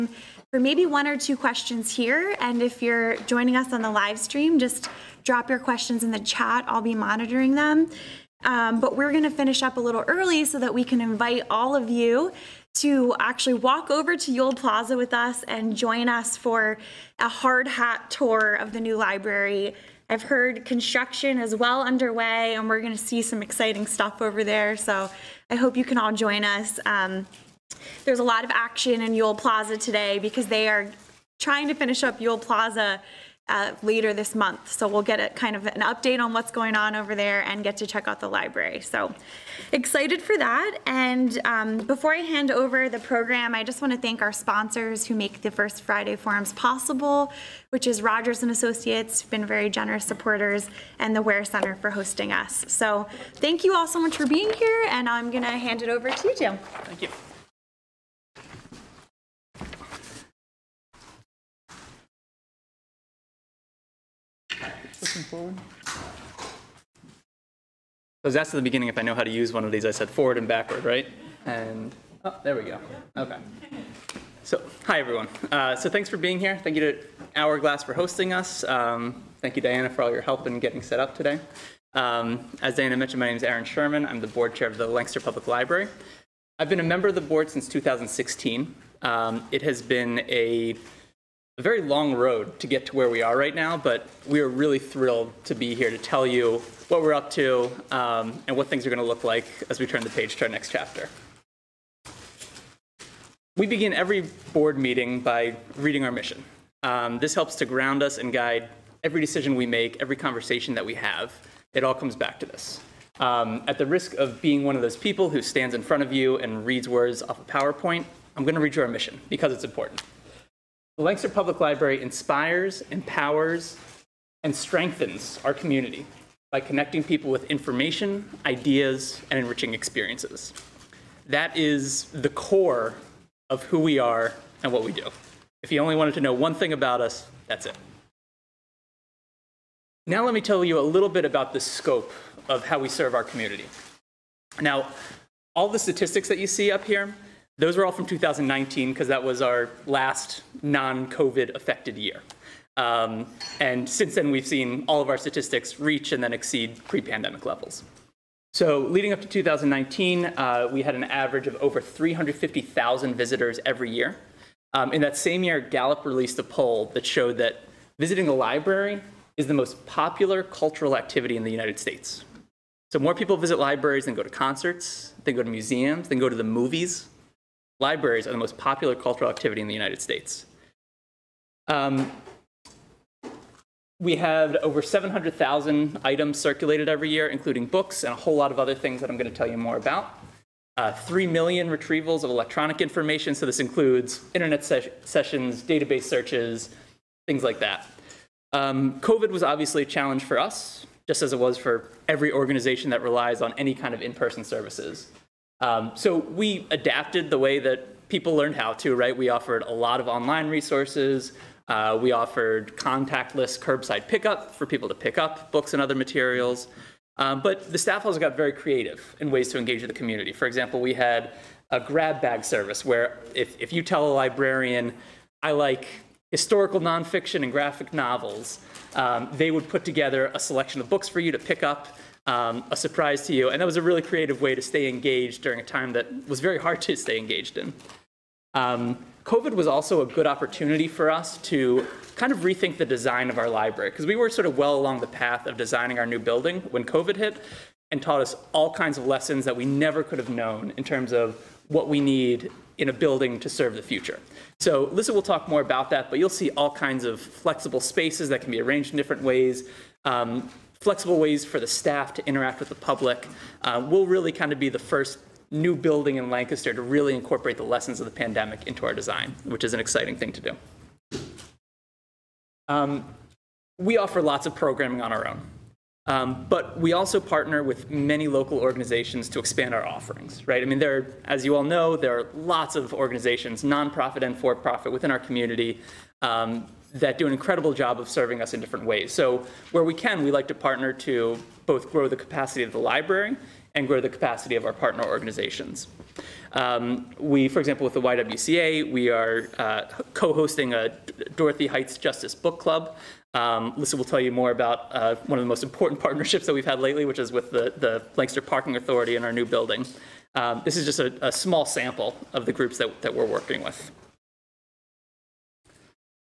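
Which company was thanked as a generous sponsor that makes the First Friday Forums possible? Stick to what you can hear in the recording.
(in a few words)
Rodgers and Associates.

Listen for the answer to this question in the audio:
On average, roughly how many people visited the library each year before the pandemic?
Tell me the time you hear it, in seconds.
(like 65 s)
161 s.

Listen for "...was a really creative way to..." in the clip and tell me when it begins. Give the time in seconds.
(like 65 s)
233 s.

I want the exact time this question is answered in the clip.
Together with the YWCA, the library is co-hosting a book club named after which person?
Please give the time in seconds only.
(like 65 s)
301 s.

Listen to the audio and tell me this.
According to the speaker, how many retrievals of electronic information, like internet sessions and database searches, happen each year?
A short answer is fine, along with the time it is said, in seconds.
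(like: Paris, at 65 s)
3 million, at 190 s.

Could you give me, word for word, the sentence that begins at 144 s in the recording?
Now, all the statistics that you see up here, those are all from 2019 because that was our last non-COVID affected year.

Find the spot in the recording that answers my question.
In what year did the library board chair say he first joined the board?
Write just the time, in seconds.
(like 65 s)
87 s.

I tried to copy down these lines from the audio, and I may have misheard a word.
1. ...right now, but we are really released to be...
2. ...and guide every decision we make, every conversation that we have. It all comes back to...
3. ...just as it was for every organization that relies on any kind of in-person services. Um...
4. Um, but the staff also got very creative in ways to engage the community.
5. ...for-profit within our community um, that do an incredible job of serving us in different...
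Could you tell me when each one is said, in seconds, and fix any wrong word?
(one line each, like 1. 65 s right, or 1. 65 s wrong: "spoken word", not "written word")
1. 93 s wrong: "thrilled", not "released"
2. 108 s right
3. 201 s right
4. 217 s right
5. 284 s right.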